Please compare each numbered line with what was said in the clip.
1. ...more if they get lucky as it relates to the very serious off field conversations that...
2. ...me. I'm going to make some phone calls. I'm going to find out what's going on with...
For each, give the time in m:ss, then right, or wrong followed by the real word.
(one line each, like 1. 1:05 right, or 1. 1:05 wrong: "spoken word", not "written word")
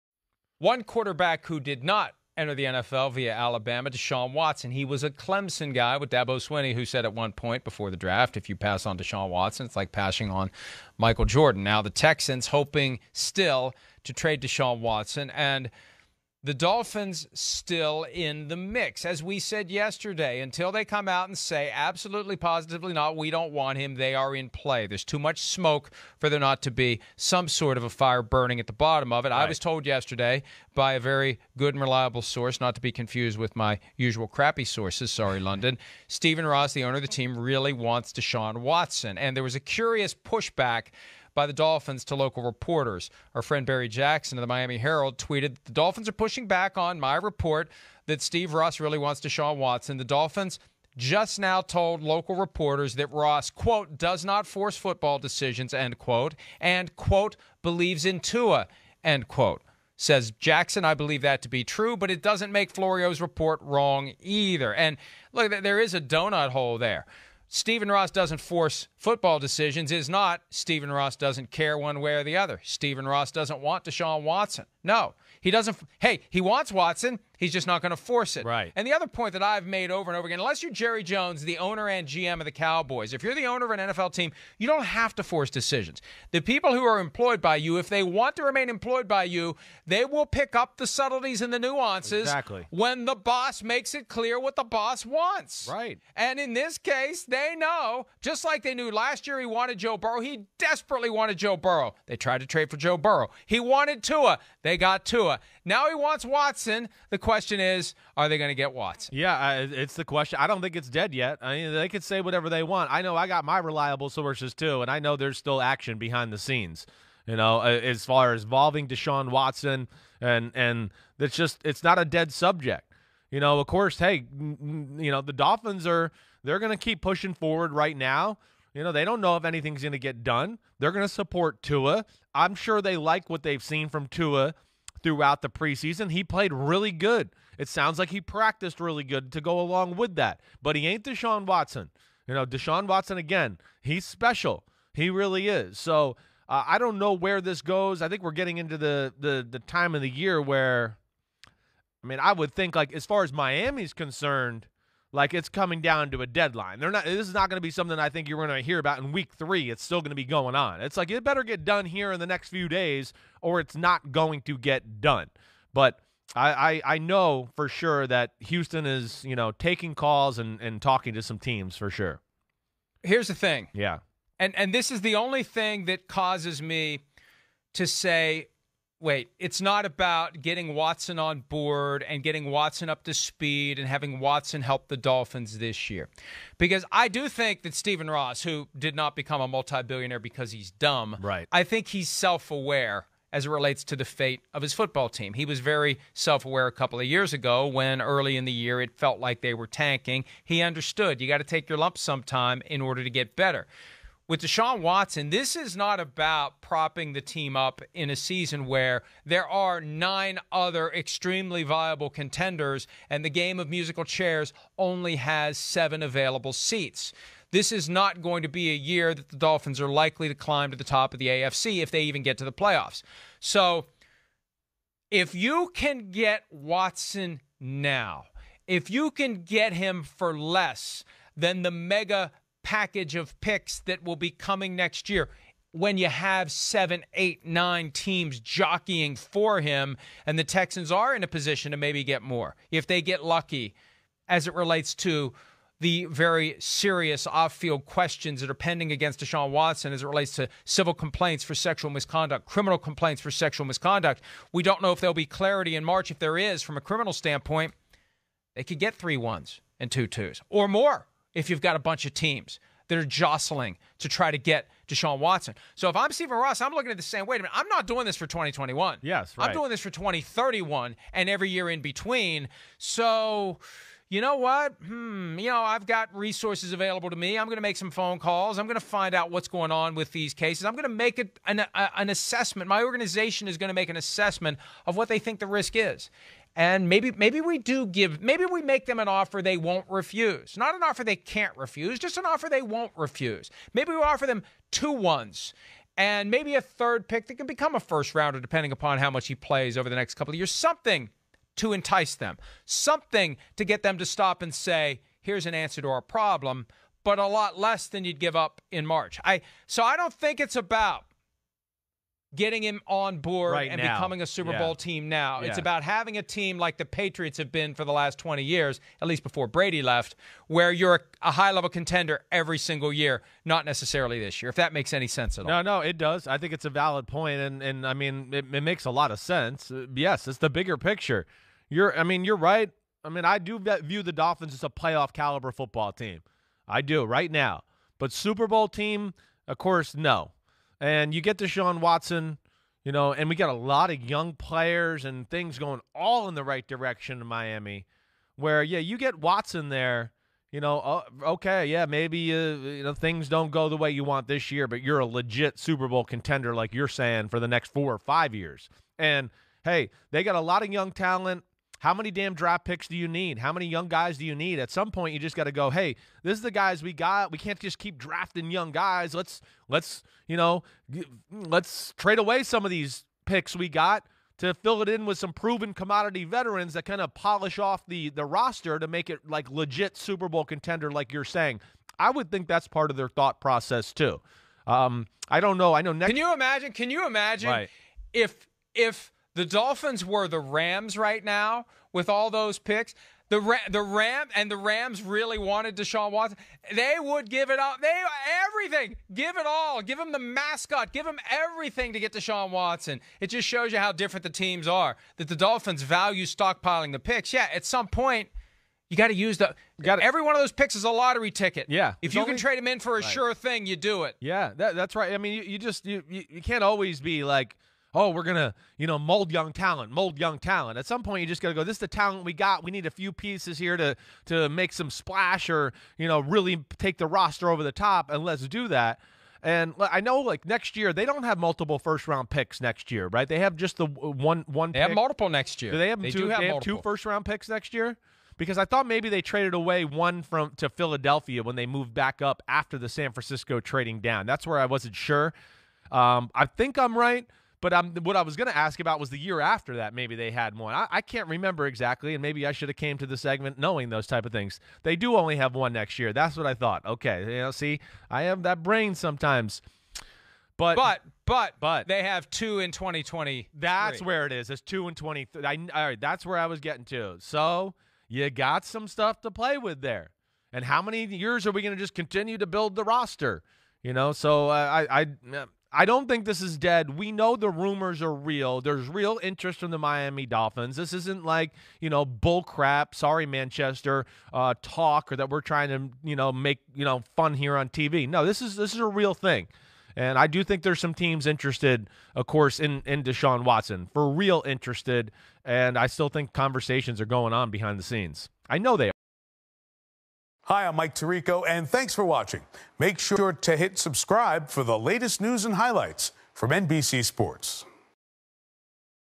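1. 4:02 wrong: "questions", not "conversations"
2. 4:37 right.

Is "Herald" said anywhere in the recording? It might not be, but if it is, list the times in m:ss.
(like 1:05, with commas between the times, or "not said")
0:44.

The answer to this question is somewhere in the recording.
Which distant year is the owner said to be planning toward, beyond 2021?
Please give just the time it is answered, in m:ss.
4:29.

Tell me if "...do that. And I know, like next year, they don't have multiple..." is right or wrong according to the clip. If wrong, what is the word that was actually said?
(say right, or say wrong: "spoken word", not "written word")
right.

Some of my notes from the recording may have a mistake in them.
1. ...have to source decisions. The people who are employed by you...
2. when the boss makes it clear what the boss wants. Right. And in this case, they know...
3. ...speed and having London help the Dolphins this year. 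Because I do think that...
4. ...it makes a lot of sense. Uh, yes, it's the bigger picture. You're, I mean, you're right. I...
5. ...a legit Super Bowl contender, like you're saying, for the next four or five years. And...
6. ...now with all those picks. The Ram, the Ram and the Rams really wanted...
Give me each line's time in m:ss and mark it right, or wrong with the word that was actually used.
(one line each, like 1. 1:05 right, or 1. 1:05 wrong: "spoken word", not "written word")
1. 1:24 wrong: "force", not "source"
2. 1:32 right
3. 3:03 wrong: "Watson", not "London"
4. 5:28 right
5. 5:54 right
6. 6:31 right.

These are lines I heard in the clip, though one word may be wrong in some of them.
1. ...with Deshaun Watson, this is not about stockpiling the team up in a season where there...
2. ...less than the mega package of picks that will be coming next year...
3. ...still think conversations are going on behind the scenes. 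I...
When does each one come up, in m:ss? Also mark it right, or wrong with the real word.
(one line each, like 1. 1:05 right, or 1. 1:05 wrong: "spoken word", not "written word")
1. 3:24 wrong: "propping", not "stockpiling"
2. 3:50 right
3. 8:15 right.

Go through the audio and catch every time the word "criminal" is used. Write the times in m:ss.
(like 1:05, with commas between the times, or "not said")
4:12, 4:16.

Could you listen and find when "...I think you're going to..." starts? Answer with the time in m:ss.
2:37.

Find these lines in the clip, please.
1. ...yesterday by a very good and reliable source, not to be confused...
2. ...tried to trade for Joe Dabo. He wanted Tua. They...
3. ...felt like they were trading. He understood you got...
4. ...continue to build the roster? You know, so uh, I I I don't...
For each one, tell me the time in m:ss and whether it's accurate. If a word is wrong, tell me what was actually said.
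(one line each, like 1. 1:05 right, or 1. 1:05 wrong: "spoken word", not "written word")
1. 0:29 right
2. 1:42 wrong: "Burrow", not "Dabo"
3. 3:18 wrong: "tanking", not "trading"
4. 7:51 right.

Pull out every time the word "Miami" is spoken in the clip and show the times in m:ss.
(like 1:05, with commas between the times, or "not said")
0:44, 2:33, 5:47, 7:59.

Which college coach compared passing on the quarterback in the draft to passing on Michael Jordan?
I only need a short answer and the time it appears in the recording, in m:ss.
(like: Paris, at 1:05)
Dabo Swinney, at 0:06.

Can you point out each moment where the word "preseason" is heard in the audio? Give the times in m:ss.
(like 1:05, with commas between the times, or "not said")
2:15.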